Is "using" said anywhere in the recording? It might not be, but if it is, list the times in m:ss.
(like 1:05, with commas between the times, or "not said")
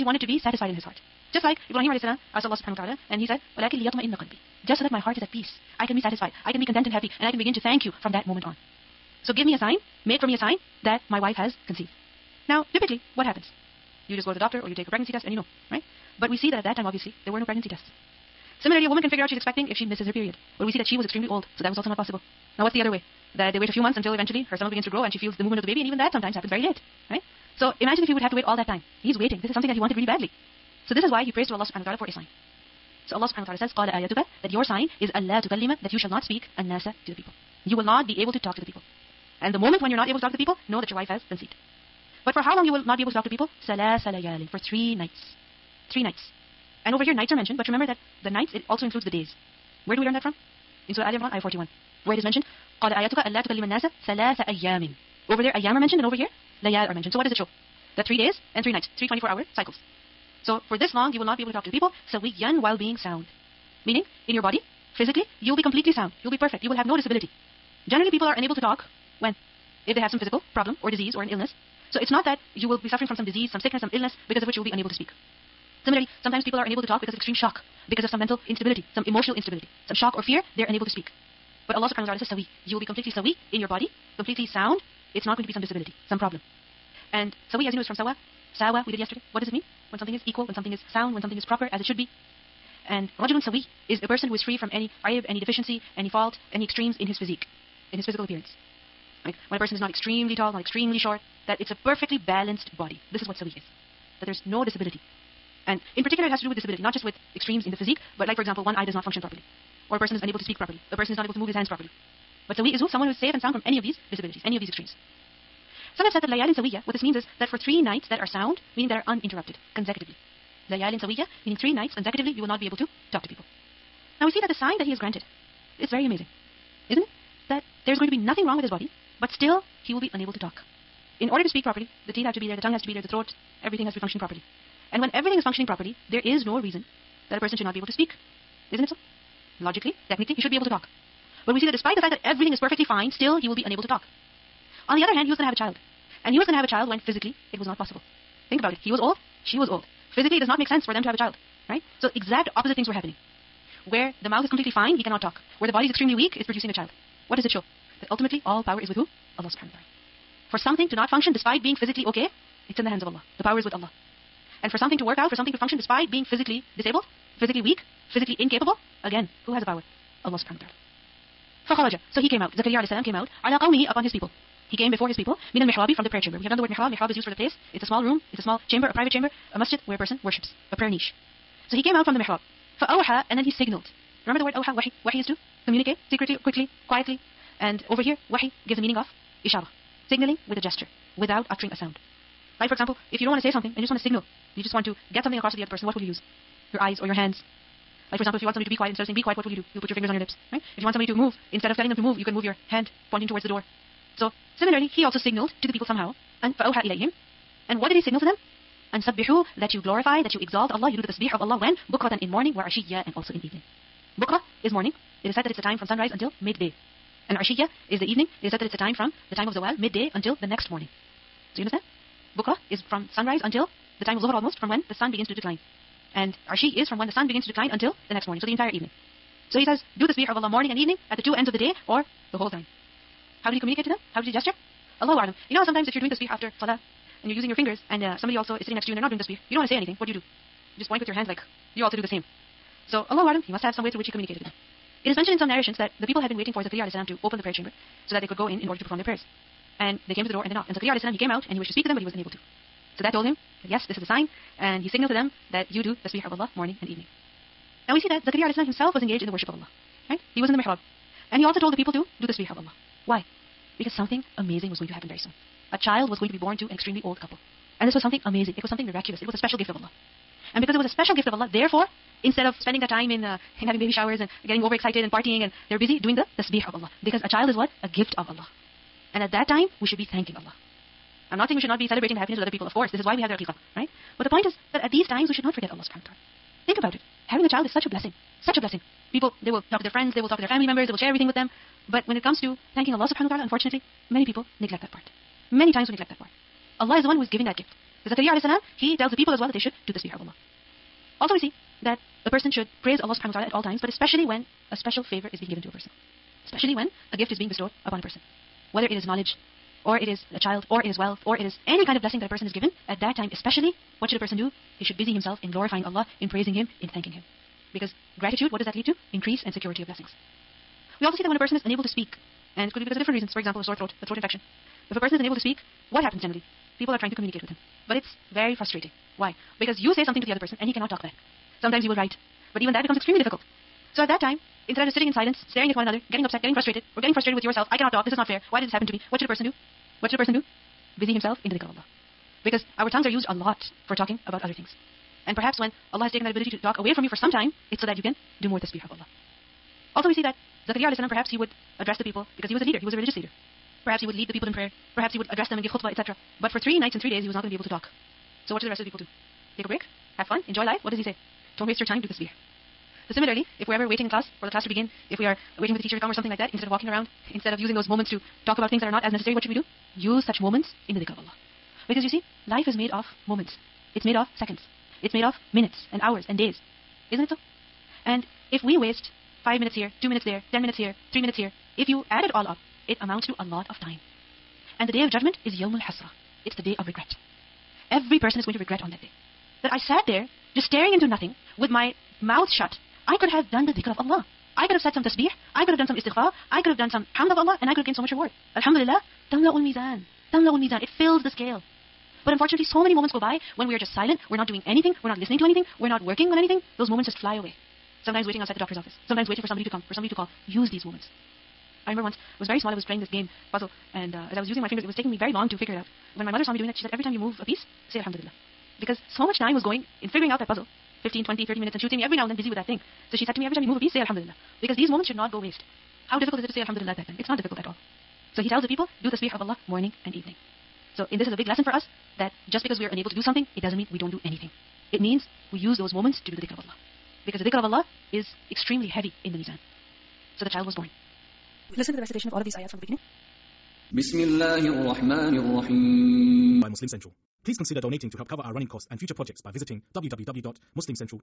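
3:57, 6:07, 6:54.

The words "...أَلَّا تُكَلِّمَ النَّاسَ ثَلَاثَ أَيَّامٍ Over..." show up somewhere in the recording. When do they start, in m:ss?
0:53.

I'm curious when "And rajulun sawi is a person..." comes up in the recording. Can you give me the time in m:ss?
1:32.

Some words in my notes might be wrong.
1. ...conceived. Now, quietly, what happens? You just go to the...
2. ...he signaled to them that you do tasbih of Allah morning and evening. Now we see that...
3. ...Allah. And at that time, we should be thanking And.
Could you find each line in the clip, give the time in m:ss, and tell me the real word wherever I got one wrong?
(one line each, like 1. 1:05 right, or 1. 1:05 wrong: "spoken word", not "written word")
1. 0:11 wrong: "typically", not "quietly"
2. 4:14 right
3. 4:38 wrong: "Allah", not "And".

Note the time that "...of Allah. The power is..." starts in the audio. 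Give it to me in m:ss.
2:43.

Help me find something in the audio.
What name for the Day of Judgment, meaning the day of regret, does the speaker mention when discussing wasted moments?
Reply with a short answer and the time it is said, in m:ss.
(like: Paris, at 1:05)
Yawmul Hasra, at 6:25.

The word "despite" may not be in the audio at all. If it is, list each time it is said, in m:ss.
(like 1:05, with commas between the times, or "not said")
2:21, 2:41, 2:45.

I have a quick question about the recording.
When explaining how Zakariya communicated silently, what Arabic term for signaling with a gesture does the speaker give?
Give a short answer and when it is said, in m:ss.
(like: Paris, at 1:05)
ishara, at 3:09.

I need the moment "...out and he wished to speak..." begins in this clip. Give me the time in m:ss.
4:11.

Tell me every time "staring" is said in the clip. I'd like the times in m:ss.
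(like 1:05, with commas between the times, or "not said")
5:35, 6:30.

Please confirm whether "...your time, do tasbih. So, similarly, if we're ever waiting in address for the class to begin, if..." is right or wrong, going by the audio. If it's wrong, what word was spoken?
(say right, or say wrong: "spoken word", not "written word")
wrong: "class", not "address".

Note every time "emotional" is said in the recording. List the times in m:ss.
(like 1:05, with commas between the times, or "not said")
1:19.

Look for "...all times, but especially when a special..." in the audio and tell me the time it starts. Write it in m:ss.
5:03.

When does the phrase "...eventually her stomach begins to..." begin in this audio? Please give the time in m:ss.
0:24.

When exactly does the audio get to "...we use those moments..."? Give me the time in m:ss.
7:15.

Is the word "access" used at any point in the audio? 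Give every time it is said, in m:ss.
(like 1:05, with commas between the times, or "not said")
not said.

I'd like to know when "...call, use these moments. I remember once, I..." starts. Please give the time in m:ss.
6:50.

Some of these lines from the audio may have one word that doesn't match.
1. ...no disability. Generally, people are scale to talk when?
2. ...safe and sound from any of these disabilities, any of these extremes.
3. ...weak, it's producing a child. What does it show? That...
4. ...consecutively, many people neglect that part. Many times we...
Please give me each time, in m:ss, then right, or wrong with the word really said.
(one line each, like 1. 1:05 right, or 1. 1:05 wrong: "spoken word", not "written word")
1. 1:06 wrong: "unable", not "scale"
2. 1:53 right
3. 2:36 right
4. 4:53 wrong: "unfortunately", not "consecutively".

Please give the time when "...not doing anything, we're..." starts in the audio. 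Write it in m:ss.
6:44.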